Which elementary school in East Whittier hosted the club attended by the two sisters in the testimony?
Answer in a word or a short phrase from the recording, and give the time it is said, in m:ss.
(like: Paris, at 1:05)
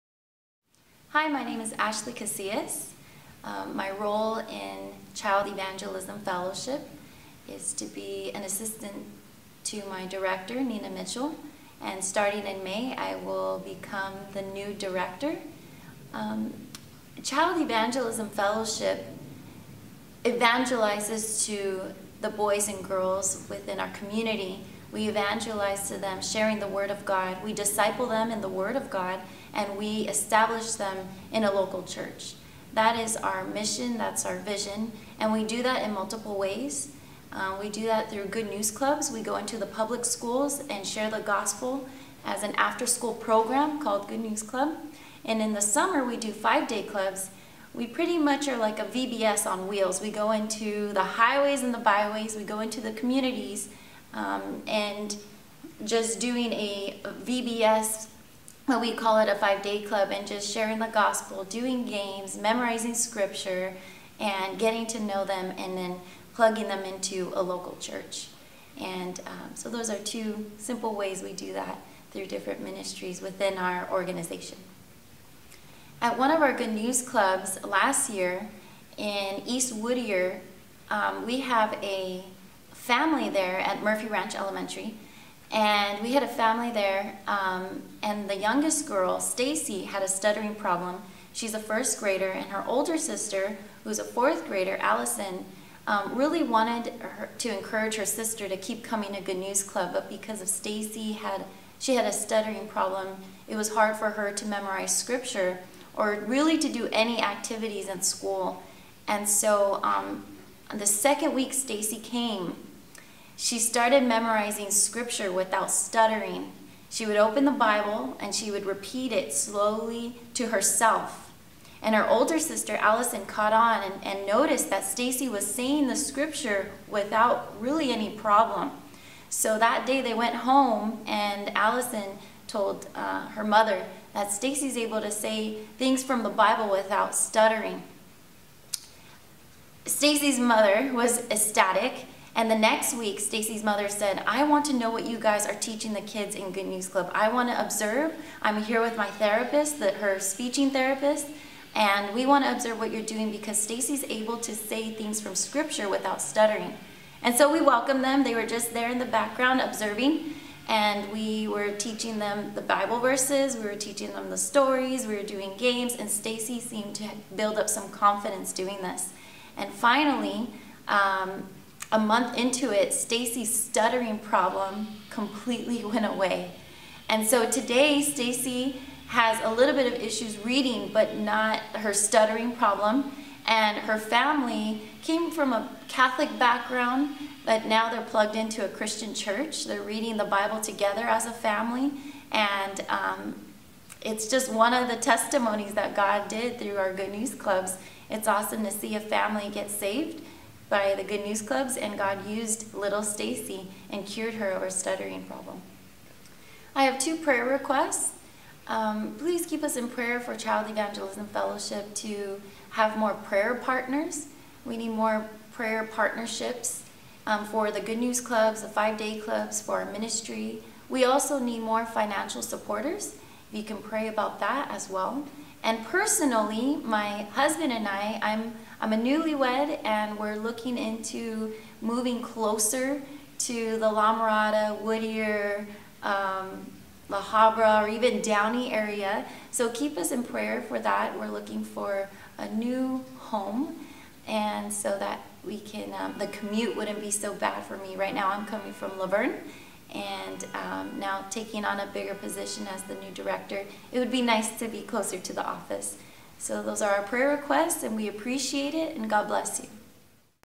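Murphy Ranch Elementary, at 1:23.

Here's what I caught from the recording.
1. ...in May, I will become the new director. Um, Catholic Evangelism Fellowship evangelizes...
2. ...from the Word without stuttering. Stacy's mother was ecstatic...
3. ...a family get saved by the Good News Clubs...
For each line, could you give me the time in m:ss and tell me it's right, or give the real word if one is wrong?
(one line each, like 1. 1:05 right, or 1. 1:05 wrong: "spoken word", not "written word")
1. 0:12 wrong: "Child", not "Catholic"
2. 2:16 wrong: "Bible", not "Word"
3. 3:18 right.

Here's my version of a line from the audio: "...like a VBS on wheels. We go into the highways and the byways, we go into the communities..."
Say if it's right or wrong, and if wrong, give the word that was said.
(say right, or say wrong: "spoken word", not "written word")
right.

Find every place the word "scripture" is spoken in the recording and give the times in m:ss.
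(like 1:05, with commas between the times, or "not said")
1:02, 1:44, 1:54, 2:05, 2:35.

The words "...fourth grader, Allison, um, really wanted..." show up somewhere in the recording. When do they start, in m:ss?
1:34.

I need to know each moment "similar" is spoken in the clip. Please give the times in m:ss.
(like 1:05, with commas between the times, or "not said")
not said.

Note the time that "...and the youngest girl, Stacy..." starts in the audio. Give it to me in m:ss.
1:28.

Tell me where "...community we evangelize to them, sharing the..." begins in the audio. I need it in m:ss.
0:23.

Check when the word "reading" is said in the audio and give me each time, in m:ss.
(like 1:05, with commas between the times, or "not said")
3:00, 3:09.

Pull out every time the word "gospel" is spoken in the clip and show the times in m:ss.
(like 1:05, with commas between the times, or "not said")
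0:41, 1:00.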